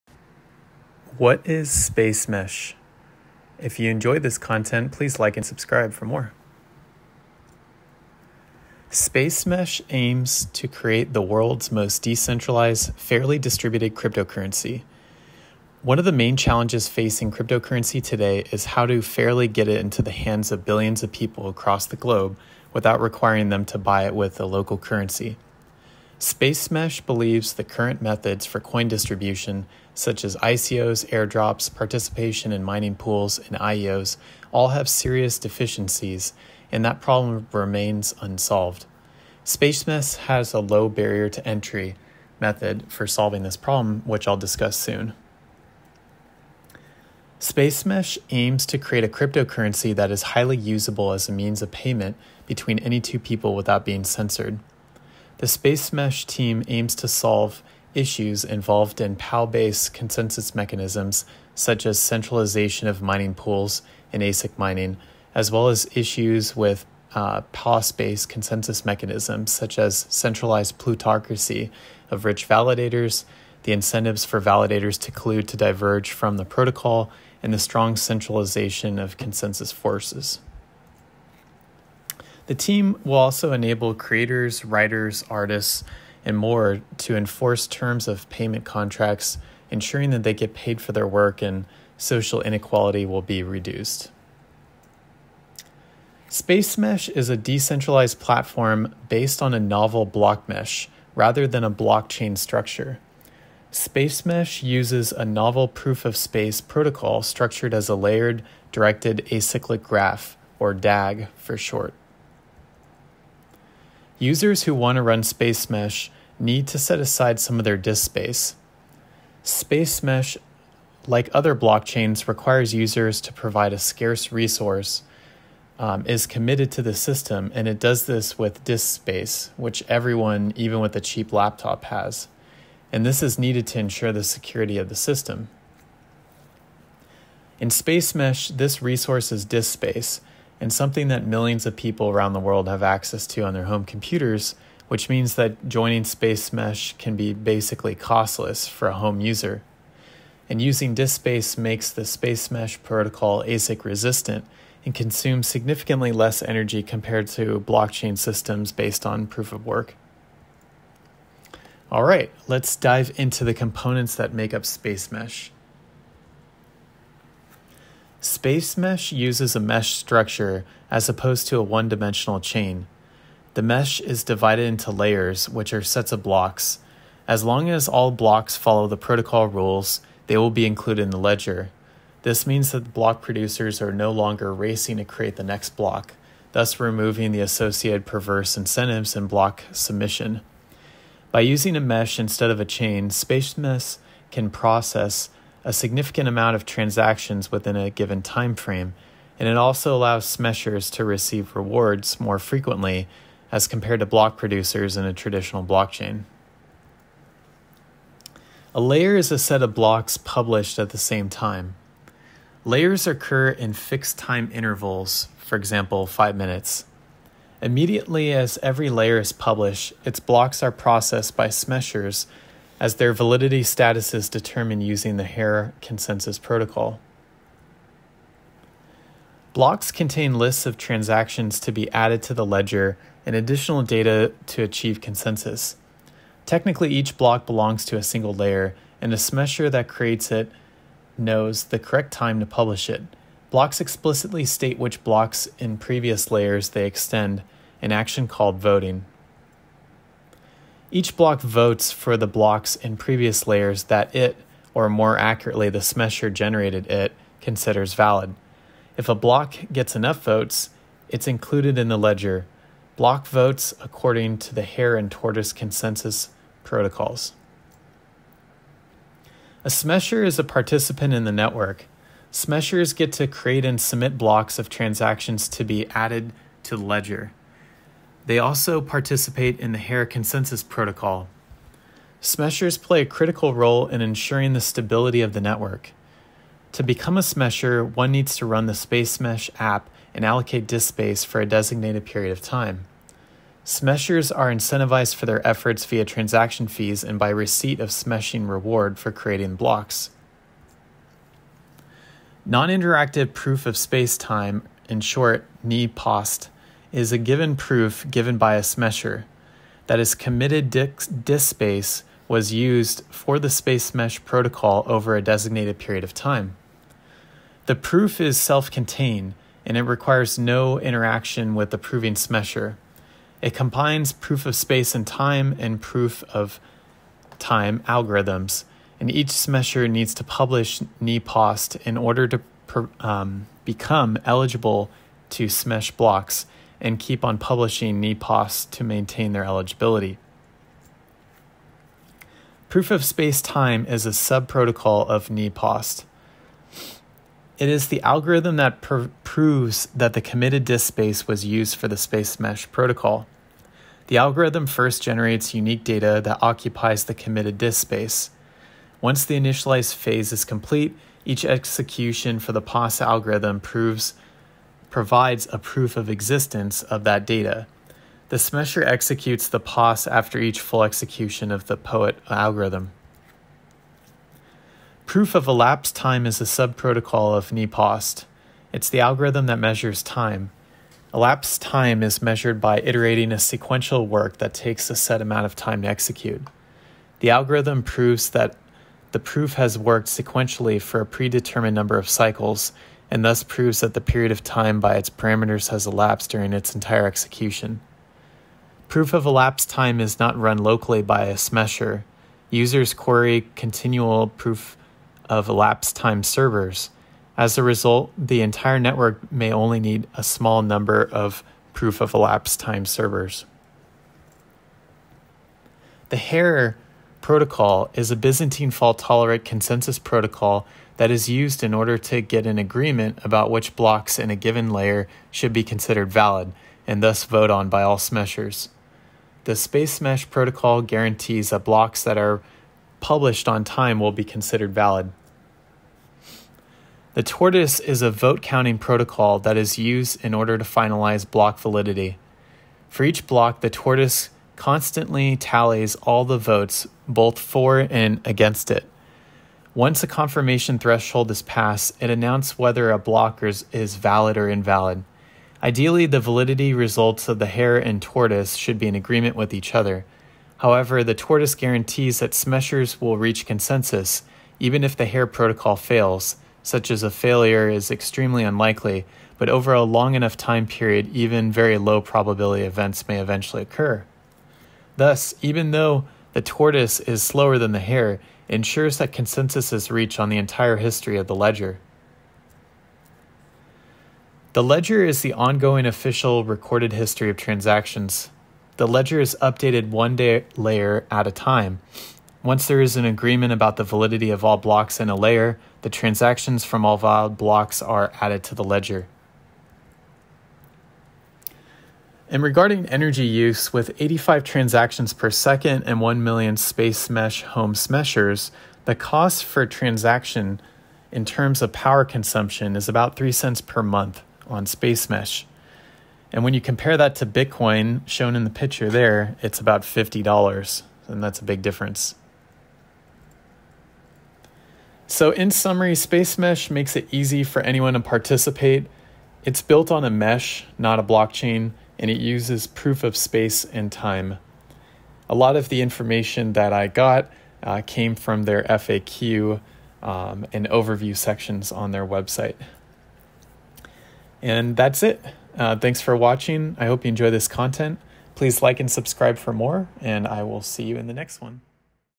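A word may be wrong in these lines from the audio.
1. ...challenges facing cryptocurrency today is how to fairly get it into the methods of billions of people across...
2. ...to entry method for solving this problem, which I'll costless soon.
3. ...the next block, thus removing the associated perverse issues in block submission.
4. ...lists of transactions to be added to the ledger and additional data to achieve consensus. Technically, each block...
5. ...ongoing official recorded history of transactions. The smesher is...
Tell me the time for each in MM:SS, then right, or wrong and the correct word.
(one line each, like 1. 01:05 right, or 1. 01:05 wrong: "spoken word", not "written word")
1. 00:16 wrong: "hands", not "methods"
2. 00:41 wrong: "discuss", not "costless"
3. 03:05 wrong: "incentives", not "issues"
4. 03:50 right
5. 08:05 wrong: "ledger", not "smesher".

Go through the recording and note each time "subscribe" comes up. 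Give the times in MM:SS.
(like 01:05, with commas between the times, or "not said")
00:05, 09:08.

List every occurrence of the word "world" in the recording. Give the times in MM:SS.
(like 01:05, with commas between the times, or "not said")
00:11, 02:22.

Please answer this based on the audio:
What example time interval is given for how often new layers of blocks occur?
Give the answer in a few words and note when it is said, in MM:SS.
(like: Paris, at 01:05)
5 minutes, at 03:36.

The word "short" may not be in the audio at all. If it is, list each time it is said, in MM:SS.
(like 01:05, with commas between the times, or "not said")
01:51, 05:05.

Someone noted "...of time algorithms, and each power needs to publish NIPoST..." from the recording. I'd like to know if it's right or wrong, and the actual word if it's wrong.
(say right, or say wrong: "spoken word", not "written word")
wrong: "smesher", not "power".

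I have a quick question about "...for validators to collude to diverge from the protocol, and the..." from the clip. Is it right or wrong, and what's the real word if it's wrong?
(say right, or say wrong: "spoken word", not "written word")
right.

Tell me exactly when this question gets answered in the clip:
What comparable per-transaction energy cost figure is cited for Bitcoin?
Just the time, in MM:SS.
08:39.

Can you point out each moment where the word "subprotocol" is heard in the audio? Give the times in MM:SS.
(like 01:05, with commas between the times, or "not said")
05:44, 06:16.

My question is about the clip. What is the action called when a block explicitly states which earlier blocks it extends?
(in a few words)
Voting.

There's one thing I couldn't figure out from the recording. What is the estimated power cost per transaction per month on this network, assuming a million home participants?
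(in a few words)
3 cents.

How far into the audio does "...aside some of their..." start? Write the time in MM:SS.
01:56.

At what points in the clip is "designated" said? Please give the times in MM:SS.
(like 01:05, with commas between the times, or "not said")
04:51, 05:15.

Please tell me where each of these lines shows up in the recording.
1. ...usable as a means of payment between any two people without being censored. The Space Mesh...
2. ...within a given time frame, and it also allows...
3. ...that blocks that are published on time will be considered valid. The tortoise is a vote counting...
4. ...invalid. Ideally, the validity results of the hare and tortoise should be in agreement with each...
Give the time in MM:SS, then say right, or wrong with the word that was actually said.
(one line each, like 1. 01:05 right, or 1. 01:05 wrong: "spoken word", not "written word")
1. 00:50 right
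2. 03:17 right
3. 07:11 right
4. 07:34 right.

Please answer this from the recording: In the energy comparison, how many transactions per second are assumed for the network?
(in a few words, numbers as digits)
85.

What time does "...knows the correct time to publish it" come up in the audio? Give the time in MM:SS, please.
04:01.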